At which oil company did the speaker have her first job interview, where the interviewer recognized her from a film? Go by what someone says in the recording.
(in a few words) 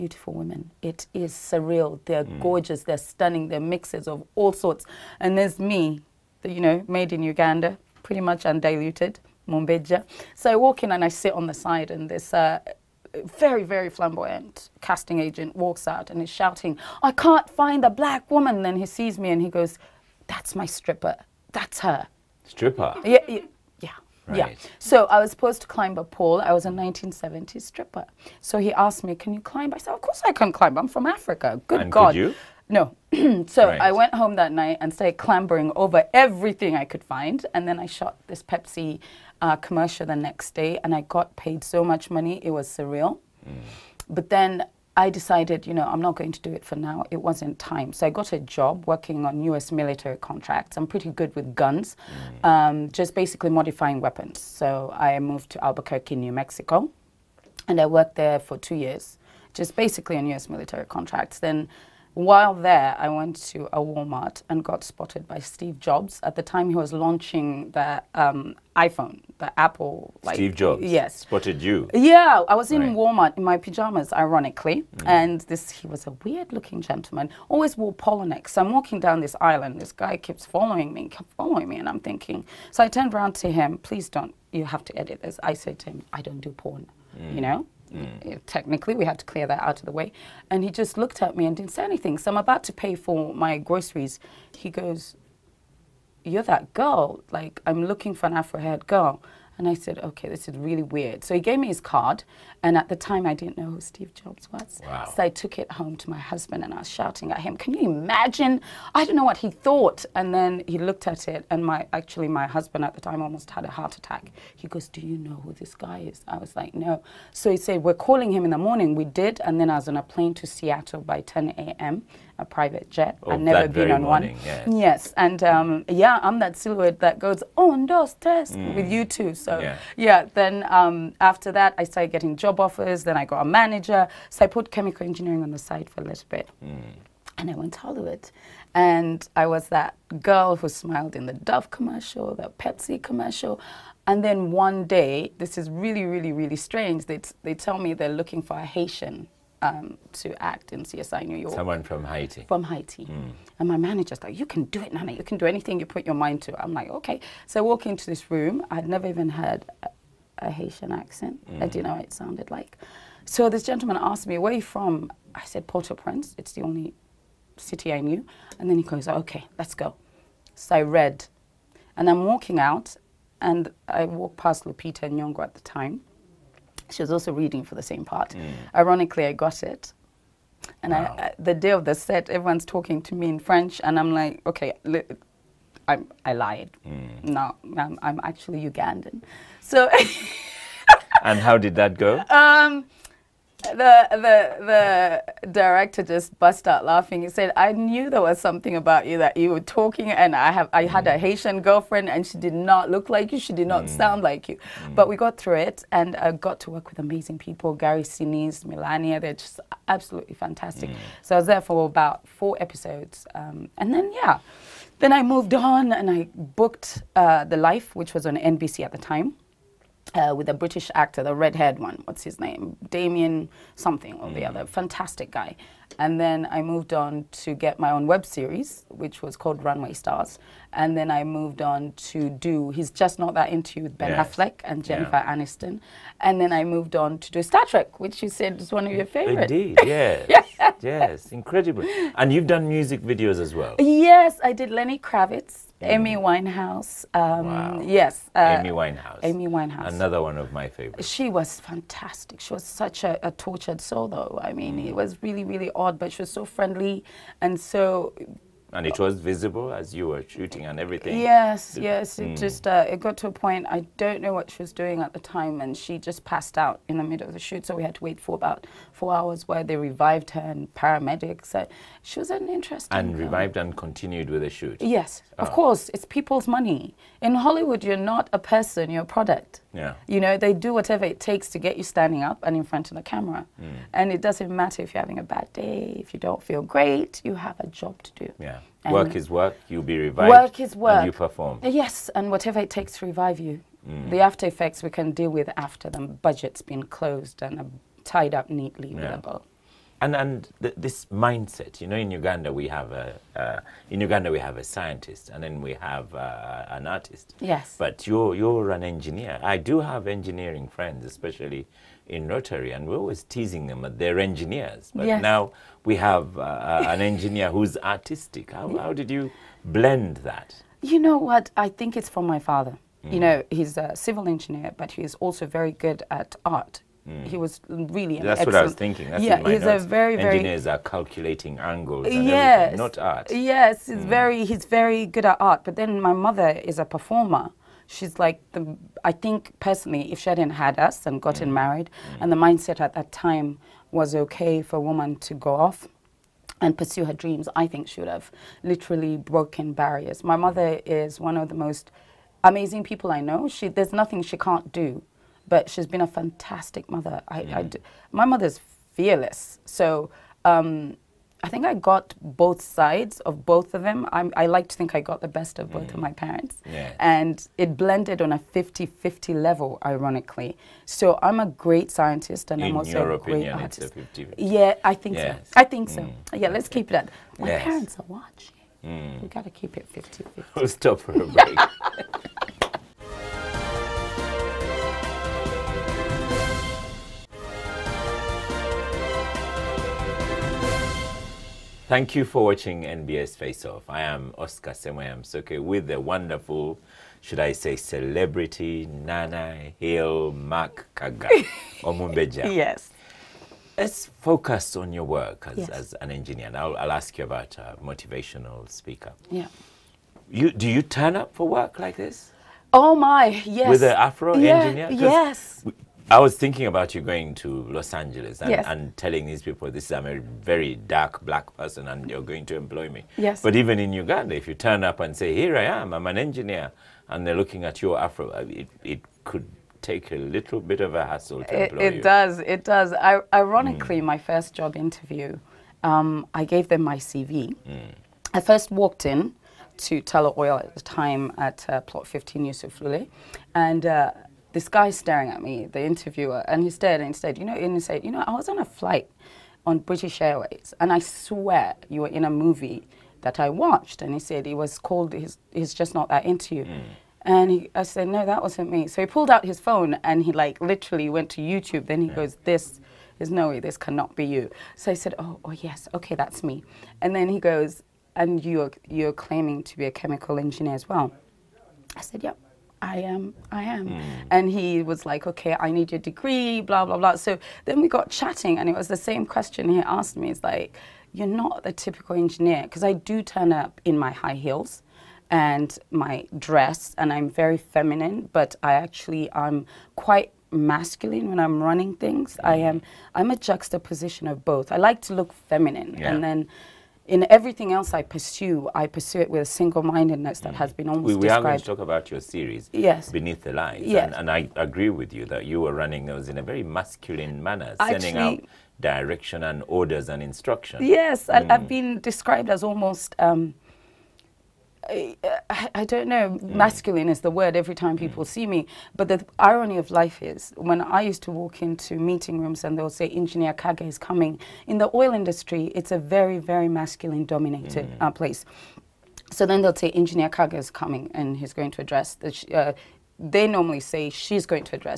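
Tullow Oil.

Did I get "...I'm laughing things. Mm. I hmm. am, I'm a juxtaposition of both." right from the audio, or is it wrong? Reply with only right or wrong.
wrong.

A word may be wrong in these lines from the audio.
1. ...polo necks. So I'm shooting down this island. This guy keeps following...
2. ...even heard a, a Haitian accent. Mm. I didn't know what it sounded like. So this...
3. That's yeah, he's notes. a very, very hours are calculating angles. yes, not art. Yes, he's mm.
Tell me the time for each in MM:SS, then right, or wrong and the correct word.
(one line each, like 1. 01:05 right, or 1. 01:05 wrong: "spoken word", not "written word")
1. 01:17 wrong: "walking", not "shooting"
2. 02:39 right
3. 05:29 wrong: "engineers", not "hours".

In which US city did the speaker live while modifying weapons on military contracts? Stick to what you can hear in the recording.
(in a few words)
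Albuquerque.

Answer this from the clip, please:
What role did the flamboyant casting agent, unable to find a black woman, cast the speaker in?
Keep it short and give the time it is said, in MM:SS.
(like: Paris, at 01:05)
1970s stripper, at 00:26.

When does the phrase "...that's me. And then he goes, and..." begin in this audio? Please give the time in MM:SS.
07:46.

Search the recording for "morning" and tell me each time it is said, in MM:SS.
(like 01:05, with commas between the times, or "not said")
01:58, 02:04.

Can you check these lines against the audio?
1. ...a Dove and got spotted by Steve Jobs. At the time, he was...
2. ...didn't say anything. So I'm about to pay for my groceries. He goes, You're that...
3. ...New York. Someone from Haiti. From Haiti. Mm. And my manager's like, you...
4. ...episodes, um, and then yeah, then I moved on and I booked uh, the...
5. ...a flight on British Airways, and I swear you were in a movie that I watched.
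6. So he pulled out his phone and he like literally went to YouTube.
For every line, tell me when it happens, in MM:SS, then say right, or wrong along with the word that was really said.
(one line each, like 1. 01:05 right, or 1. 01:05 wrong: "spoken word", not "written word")
1. 01:03 wrong: "Walmart", not "Dove"
2. 01:31 right
3. 02:31 right
4. 03:32 right
5. 07:28 right
6. 07:38 right.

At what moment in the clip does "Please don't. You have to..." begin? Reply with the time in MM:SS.
01:23.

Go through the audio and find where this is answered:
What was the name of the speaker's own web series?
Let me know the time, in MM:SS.
03:49.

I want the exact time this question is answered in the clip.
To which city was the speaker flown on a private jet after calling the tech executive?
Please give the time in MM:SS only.
02:00.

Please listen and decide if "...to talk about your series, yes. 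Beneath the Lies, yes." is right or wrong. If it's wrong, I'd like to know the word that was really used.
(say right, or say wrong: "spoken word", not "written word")
right.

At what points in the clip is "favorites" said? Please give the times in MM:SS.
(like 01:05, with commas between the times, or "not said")
03:59, 04:10.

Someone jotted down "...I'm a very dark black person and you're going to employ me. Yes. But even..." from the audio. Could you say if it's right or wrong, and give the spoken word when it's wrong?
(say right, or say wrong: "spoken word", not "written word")
right.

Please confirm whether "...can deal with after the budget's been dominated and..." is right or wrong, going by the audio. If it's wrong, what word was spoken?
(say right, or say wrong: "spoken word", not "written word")
wrong: "closed", not "dominated".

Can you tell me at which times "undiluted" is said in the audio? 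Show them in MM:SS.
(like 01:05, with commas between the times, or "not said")
00:08.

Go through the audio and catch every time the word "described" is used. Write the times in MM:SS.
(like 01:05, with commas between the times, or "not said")
08:21, 08:31.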